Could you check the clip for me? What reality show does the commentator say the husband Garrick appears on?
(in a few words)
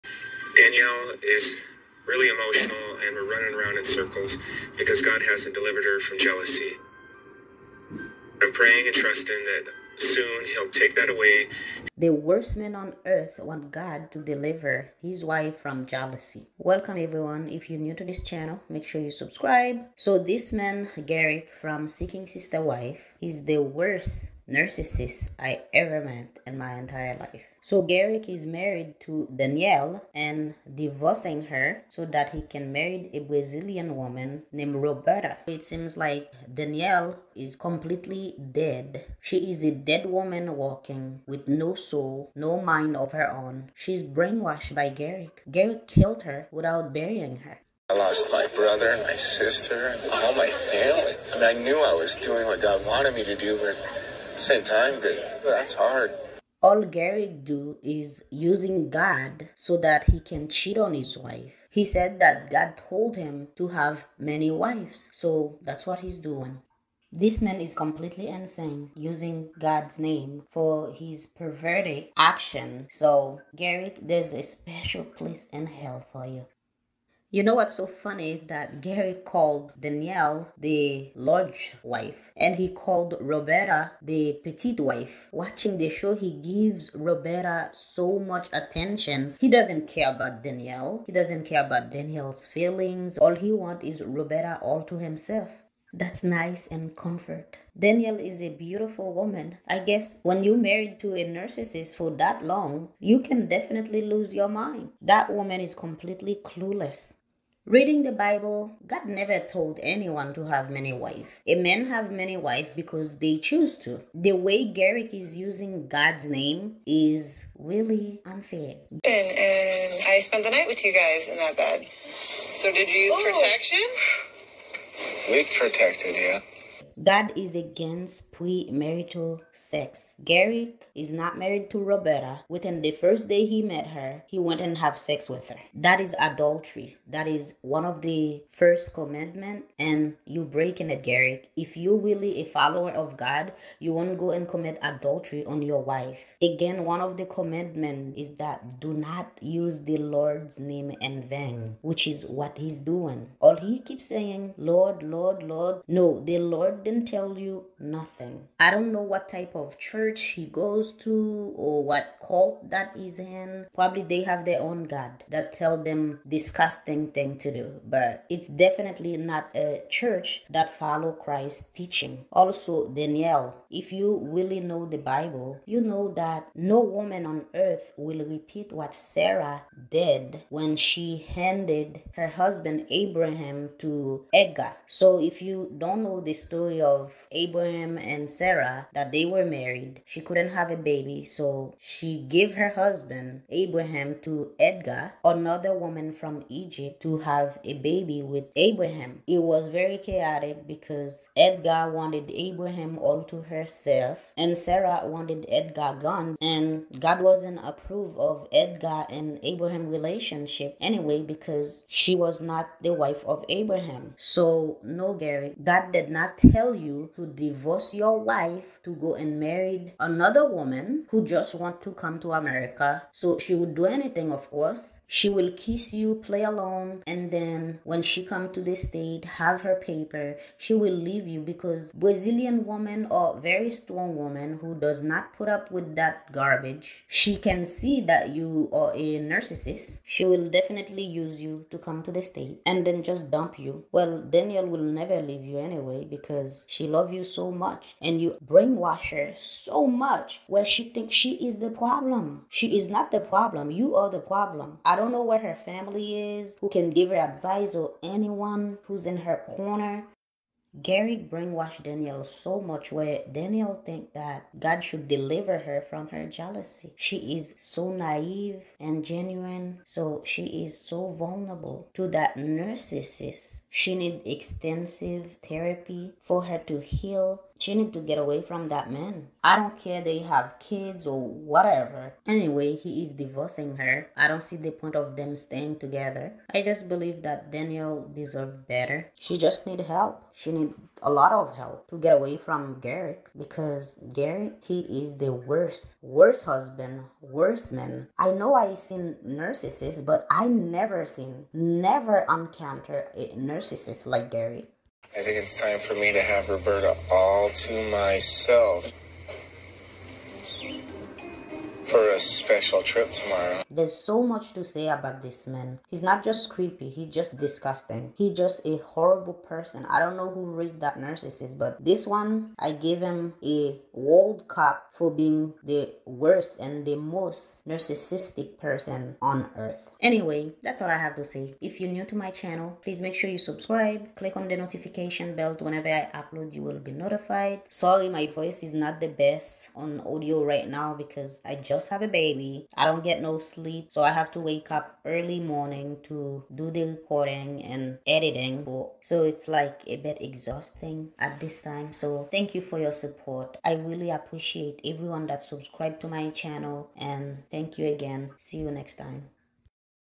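Seeking Sister Wife.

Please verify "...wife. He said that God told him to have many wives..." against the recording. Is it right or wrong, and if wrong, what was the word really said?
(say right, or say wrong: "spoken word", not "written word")
right.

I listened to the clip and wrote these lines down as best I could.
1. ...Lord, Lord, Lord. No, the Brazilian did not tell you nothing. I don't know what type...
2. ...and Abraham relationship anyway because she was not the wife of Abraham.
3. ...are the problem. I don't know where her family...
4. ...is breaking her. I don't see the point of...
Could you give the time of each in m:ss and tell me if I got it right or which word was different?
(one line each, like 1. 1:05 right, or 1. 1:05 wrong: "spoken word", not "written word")
1. 2:34 wrong: "Lord", not "Brazilian"
2. 3:29 right
3. 4:13 right
4. 4:43 wrong: "divorcing", not "breaking".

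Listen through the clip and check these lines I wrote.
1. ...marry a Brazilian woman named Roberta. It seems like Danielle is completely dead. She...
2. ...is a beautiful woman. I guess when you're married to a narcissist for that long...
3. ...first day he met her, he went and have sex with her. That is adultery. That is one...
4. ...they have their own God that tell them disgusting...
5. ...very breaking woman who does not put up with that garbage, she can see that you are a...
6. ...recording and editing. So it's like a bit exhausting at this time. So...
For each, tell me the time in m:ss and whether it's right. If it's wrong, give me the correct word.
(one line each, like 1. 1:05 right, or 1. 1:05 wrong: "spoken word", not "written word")
1. 0:32 right
2. 1:38 right
3. 2:12 right
4. 2:44 right
5. 3:53 wrong: "strong", not "breaking"
6. 5:46 right.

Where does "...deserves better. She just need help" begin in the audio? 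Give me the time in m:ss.
4:48.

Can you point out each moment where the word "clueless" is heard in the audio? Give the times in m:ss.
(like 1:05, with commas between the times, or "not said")
1:46.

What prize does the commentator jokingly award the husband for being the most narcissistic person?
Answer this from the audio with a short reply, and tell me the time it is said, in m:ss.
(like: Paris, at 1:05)
a World Cup, at 5:23.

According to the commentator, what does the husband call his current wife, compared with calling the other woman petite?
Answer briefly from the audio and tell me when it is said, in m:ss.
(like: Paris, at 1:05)
the large wife, at 1:20.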